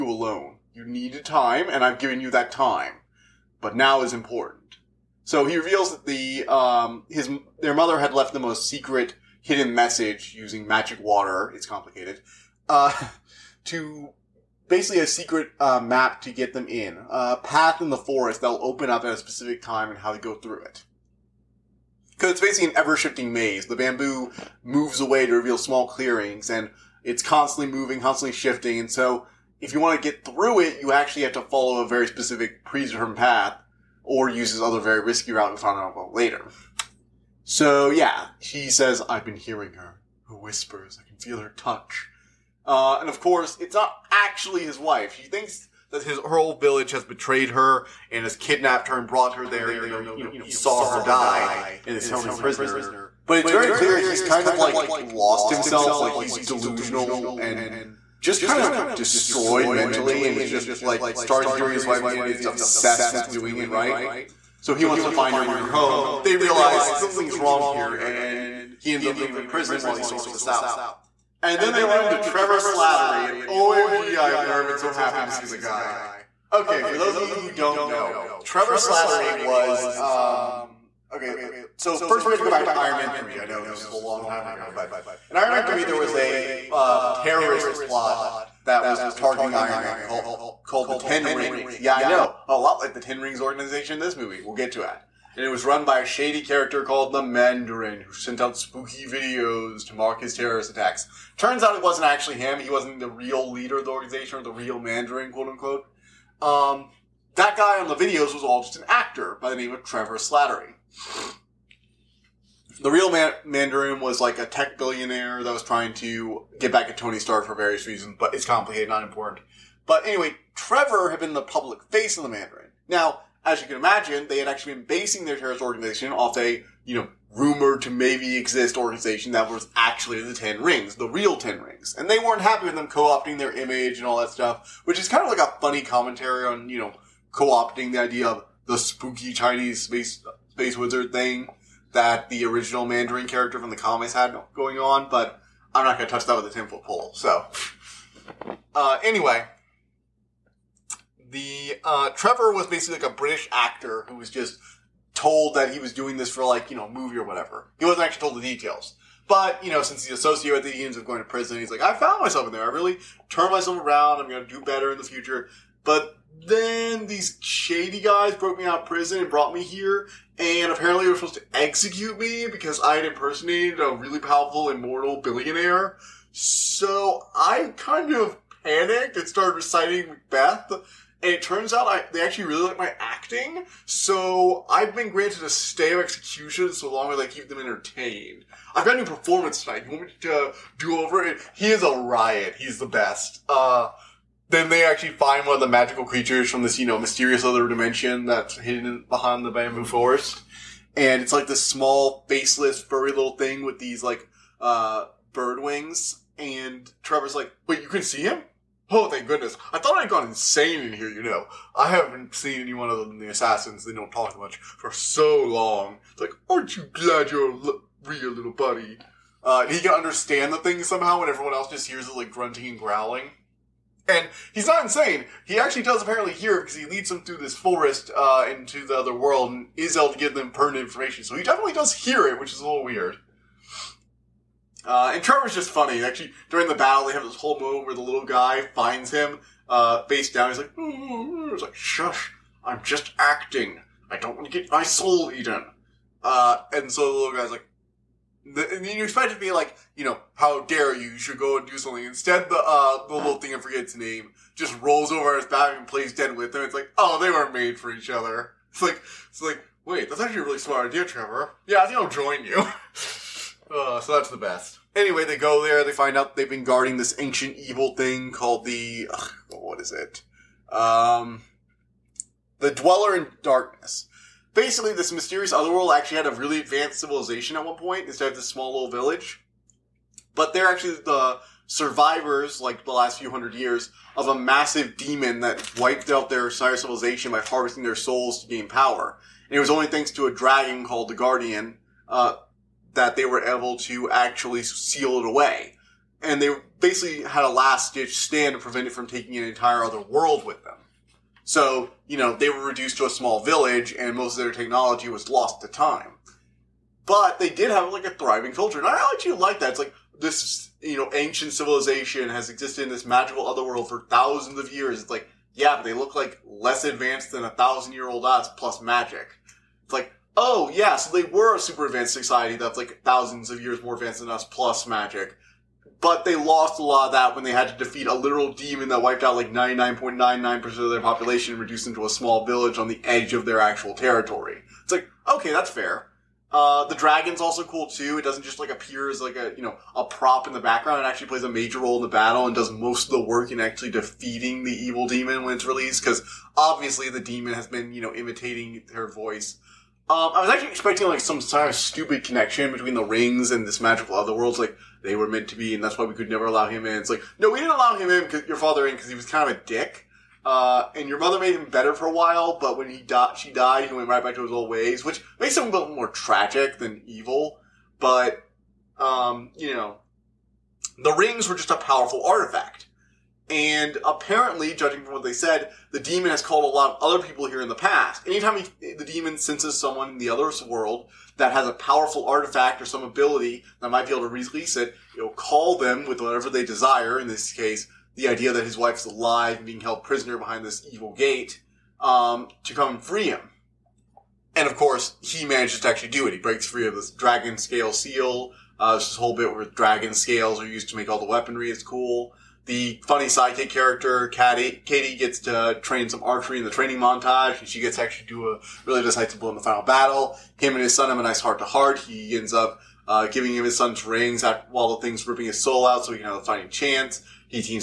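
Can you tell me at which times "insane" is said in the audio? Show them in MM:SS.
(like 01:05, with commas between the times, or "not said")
03:30, 03:44.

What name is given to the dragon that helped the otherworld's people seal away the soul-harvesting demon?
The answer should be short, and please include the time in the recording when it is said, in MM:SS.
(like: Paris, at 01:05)
the Guardian, at 04:51.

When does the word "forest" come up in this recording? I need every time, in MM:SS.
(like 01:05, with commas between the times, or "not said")
00:17, 03:19, 03:47.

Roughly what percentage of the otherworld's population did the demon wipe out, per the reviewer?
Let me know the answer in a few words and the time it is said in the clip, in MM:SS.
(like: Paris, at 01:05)
99.99%, at 05:29.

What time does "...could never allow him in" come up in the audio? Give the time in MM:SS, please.
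05:56.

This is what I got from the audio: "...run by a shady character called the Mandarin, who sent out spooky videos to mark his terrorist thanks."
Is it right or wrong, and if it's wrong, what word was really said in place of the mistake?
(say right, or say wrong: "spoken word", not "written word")
wrong: "attacks", not "thanks".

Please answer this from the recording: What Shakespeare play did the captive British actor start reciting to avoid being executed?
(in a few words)
Macbeth.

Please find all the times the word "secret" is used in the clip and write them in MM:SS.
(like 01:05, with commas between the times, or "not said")
00:08, 00:15.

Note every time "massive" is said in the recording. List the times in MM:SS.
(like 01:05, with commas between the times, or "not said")
04:44.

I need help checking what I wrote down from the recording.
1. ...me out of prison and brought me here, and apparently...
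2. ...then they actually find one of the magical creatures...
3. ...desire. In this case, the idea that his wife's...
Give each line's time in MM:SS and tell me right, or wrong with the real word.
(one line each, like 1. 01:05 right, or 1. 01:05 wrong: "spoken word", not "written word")
1. 02:48 right
2. 03:14 right
3. 06:26 right.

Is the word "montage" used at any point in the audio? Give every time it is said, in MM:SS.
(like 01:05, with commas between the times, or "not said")
06:46.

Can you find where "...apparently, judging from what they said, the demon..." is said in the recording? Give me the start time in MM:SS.
06:14.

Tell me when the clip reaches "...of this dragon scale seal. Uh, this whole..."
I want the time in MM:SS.
06:36.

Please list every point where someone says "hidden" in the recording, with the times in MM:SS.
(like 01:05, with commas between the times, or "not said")
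00:09, 03:18.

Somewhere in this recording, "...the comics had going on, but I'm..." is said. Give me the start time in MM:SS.
02:23.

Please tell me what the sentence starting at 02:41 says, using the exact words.
He's like, I found myself in there.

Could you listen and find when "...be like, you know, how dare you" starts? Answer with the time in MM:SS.
04:09.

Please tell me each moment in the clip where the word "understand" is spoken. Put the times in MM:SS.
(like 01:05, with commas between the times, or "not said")
03:39.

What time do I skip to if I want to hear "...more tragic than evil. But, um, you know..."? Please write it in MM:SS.
06:05.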